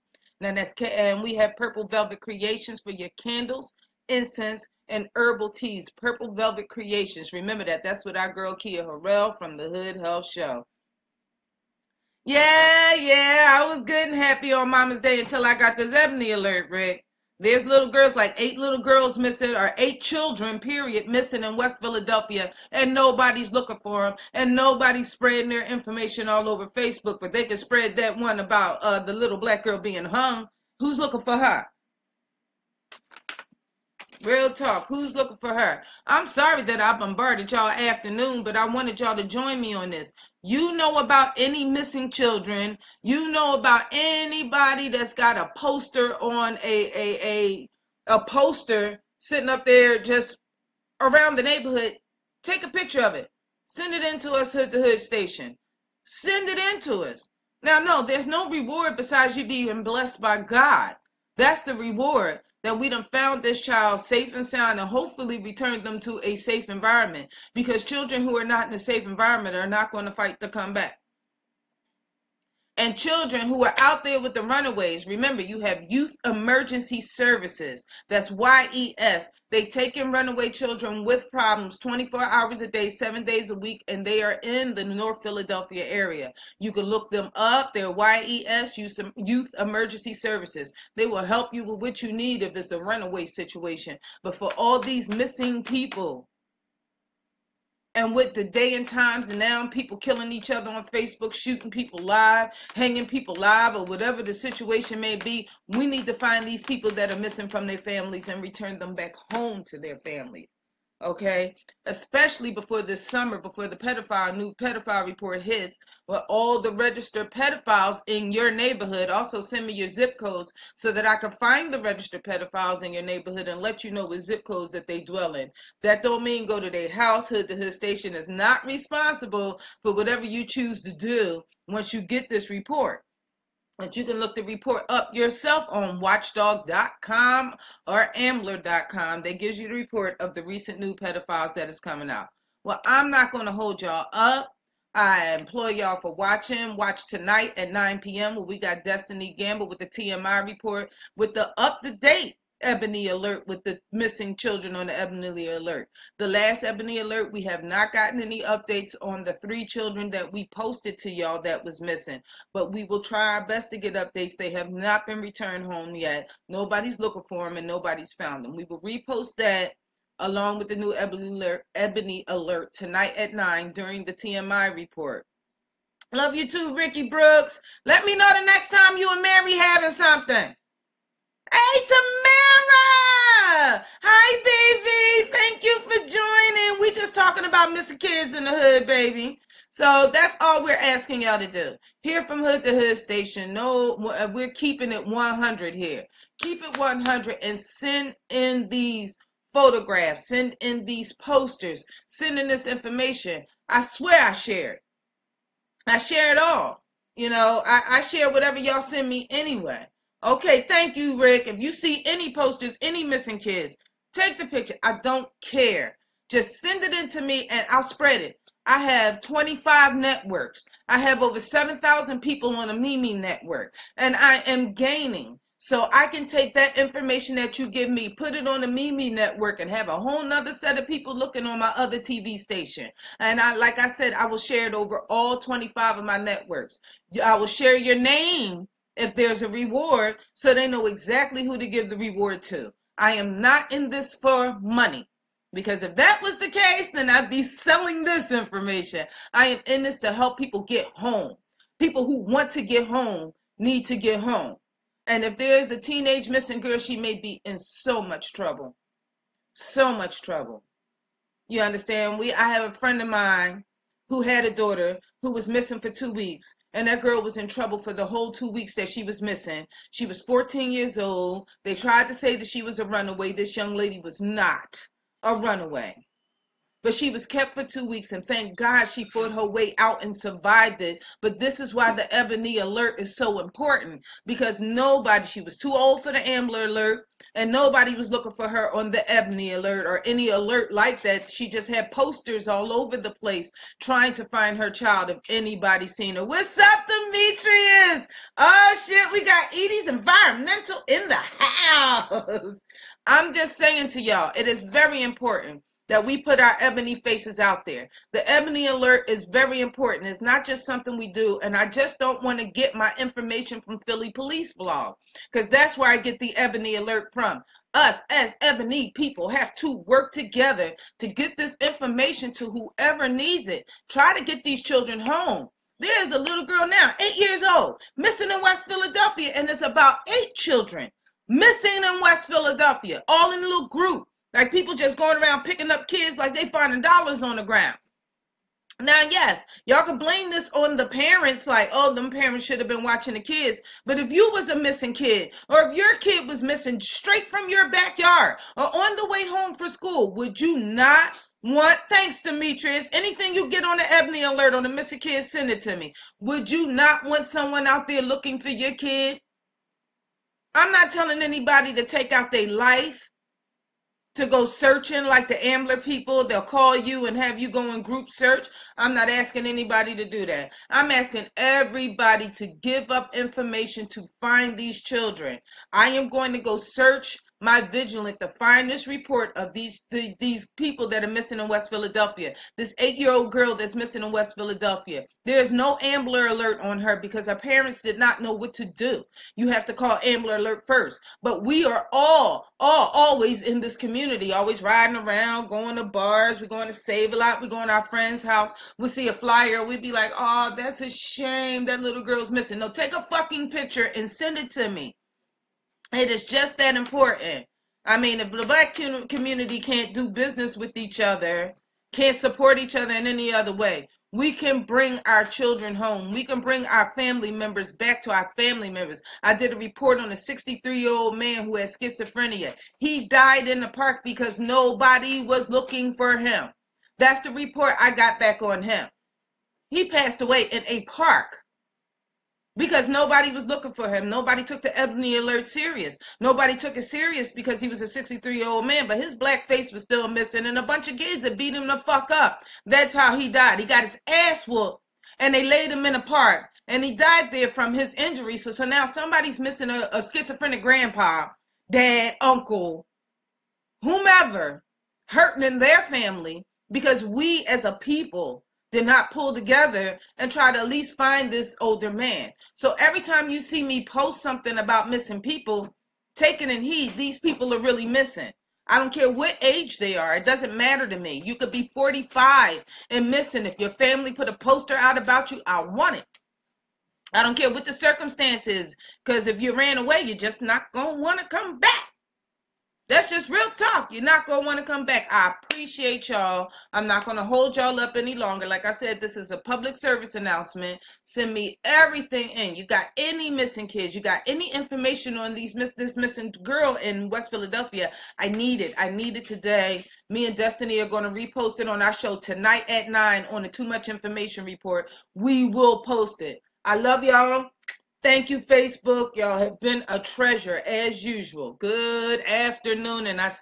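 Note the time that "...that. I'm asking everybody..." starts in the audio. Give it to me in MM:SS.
06:10.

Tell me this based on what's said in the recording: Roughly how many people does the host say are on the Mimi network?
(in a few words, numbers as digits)
over 7,000.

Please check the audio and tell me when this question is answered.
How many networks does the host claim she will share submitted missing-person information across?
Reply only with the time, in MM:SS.
03:39.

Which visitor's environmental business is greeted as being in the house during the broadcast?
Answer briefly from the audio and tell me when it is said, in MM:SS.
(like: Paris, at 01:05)
Edie's Environmental, at 04:59.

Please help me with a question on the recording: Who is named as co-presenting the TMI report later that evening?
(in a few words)
Destiny Gamble.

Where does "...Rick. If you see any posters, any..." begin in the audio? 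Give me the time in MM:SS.
03:31.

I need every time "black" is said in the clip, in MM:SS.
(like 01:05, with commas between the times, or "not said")
00:29, 06:48, 07:19.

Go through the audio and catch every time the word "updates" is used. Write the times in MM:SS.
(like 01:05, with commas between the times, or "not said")
02:38, 02:43.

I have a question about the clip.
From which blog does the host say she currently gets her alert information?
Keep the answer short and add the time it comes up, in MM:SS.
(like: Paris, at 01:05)
Philly Police blog, at 05:13.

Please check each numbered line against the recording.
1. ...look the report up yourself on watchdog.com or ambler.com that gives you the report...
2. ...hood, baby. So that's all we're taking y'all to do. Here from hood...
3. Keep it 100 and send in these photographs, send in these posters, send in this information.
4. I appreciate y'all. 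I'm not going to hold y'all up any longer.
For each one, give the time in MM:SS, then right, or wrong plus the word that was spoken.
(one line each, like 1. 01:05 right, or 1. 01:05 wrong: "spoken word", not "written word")
1. 02:14 right
2. 03:08 wrong: "asking", not "taking"
3. 03:16 right
4. 08:05 right.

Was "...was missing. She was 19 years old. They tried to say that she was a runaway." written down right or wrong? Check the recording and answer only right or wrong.
wrong.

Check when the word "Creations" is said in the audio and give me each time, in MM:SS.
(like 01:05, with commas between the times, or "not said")
00:02, 00:06.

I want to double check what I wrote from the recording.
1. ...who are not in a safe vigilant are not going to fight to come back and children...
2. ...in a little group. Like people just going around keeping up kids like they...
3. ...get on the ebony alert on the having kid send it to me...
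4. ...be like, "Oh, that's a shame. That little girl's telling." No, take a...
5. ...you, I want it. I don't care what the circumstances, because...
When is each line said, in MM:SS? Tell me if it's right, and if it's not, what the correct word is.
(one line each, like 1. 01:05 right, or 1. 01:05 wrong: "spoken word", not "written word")
1. 01:08 wrong: "environment", not "vigilant"
2. 05:33 wrong: "picking", not "keeping"
3. 05:53 wrong: "missing", not "having"
4. 06:39 wrong: "missing", not "telling"
5. 07:55 right.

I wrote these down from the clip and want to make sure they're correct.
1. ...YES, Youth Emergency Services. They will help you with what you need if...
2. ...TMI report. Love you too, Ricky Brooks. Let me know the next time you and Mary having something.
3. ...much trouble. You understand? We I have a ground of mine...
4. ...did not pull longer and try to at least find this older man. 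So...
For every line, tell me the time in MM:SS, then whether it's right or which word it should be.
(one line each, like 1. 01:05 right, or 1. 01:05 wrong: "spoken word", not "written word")
1. 01:27 right
2. 02:54 right
3. 04:19 wrong: "friend", not "ground"
4. 07:38 wrong: "together", not "longer".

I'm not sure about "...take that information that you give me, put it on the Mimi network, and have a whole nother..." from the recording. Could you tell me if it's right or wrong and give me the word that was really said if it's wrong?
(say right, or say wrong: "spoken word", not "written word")
right.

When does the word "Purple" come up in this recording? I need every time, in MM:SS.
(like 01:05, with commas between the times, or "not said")
00:01, 00:05.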